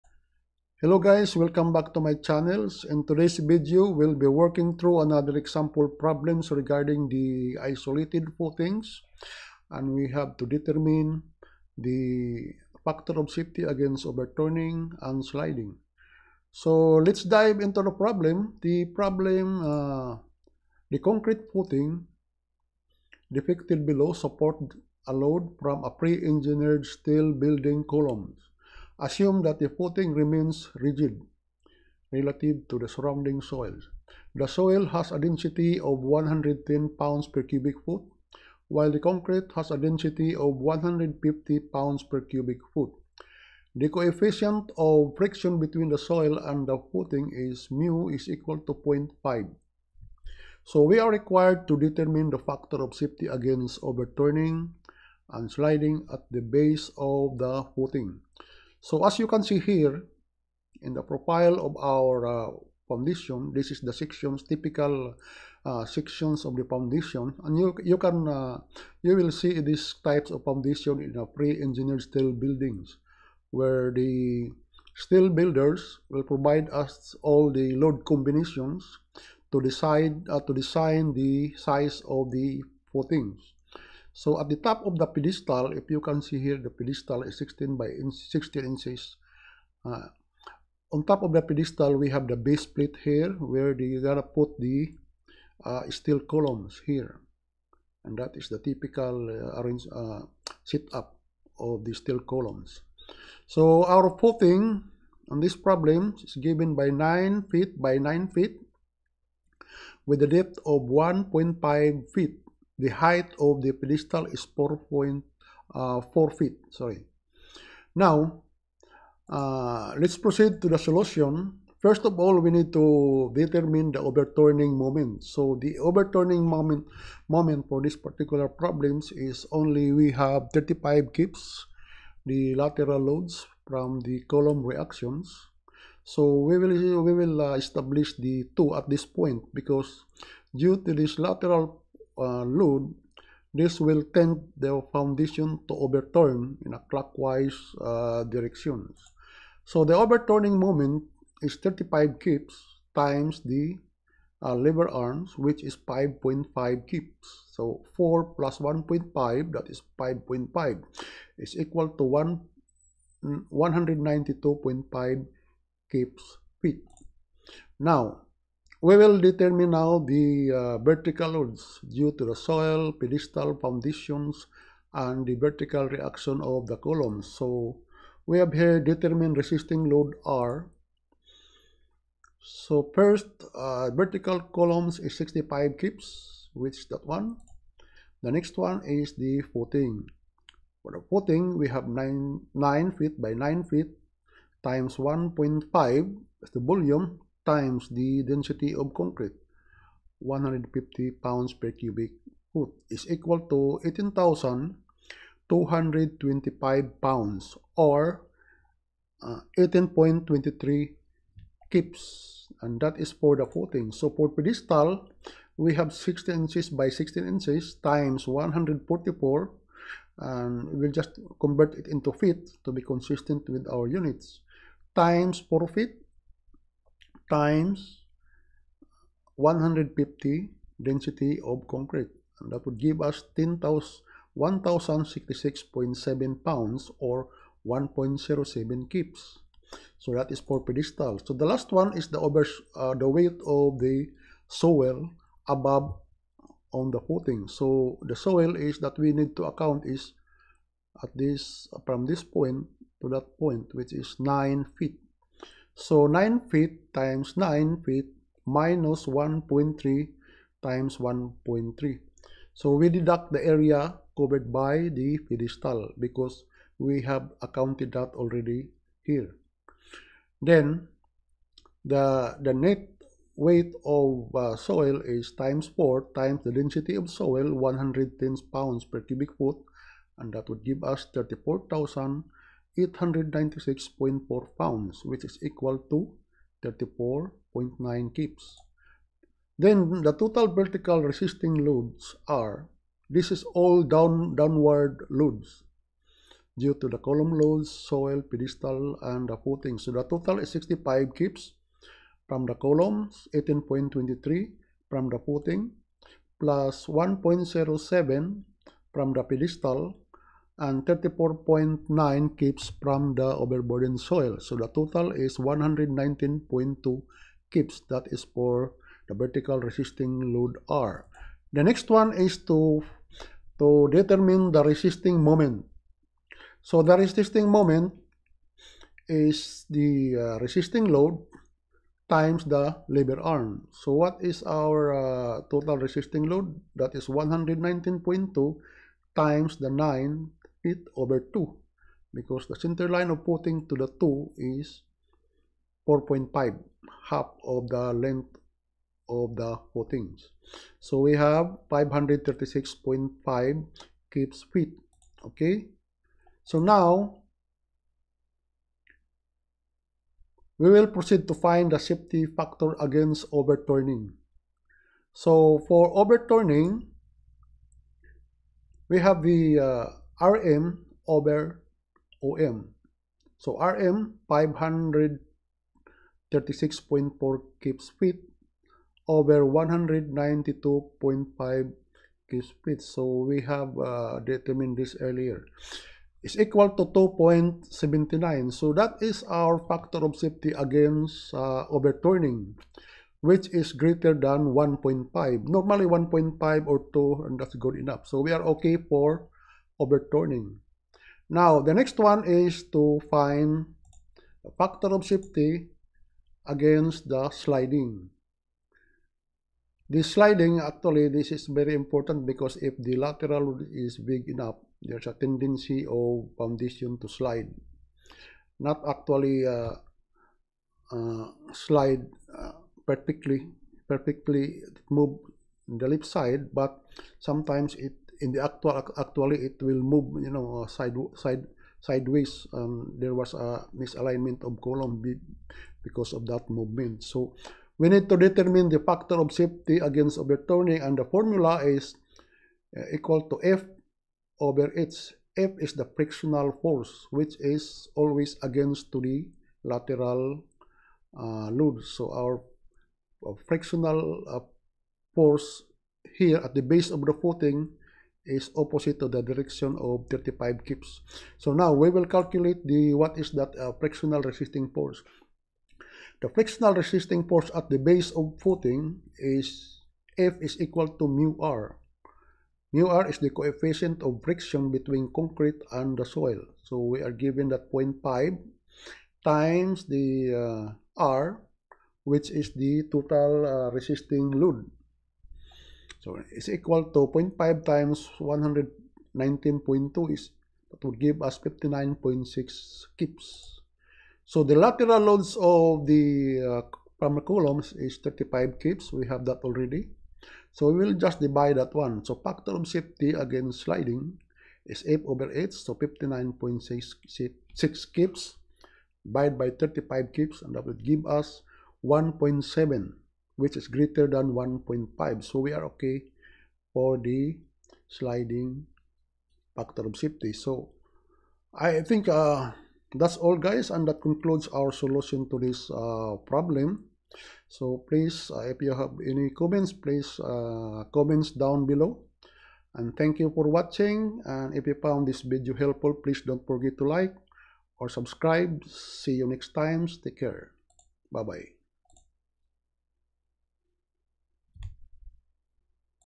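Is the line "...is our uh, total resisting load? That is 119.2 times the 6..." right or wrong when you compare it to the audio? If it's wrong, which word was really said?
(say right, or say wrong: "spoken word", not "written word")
wrong: "9", not "6".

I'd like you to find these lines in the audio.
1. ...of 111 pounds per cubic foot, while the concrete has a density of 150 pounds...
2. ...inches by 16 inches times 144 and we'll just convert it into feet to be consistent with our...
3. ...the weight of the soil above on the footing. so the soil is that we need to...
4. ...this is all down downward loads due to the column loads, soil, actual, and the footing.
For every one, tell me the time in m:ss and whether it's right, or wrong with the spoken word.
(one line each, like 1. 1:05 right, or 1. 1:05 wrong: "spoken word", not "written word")
1. 0:35 wrong: "110", not "111"
2. 3:36 right
3. 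4:02 right
4. 4:53 wrong: "pedestal", not "actual".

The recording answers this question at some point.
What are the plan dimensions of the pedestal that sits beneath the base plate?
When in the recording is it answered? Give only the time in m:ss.
1:27.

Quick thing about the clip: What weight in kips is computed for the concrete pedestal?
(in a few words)
1.07 kips.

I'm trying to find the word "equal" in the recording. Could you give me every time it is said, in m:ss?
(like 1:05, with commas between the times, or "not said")
0:48, 2:41, 3:23, 4:45, 6:26, 7:22, 7:50, 8:06.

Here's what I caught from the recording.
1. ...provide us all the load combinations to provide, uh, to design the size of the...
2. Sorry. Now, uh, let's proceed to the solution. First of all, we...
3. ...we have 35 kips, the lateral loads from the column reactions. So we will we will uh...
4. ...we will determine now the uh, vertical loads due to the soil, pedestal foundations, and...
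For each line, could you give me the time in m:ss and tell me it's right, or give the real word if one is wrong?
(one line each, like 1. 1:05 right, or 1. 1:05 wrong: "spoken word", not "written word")
1. 1:16 wrong: "decide", not "provide"
2. 1:56 right
3. 2:09 right
4. 2:48 right.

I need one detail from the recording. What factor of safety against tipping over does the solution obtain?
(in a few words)
2.79.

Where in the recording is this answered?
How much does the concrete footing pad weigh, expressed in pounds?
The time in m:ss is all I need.
3:23.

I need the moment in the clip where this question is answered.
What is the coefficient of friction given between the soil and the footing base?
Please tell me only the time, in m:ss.
0:47.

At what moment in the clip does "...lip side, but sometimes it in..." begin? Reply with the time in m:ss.
7:05.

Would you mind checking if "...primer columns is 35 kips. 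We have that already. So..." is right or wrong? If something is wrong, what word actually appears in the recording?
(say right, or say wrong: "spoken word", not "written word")
right.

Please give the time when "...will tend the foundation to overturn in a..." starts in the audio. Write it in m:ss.
2:23.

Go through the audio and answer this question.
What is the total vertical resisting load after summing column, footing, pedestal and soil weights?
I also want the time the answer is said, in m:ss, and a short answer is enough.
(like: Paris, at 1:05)
119.2 kips, at 5:15.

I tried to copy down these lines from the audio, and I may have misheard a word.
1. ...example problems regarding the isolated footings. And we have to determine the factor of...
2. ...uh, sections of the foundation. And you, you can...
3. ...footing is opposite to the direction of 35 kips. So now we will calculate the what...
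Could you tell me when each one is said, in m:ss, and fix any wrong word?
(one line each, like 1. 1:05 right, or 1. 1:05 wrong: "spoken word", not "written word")
1. 0:05 right
2. 1:05 right
3. 7:37 right.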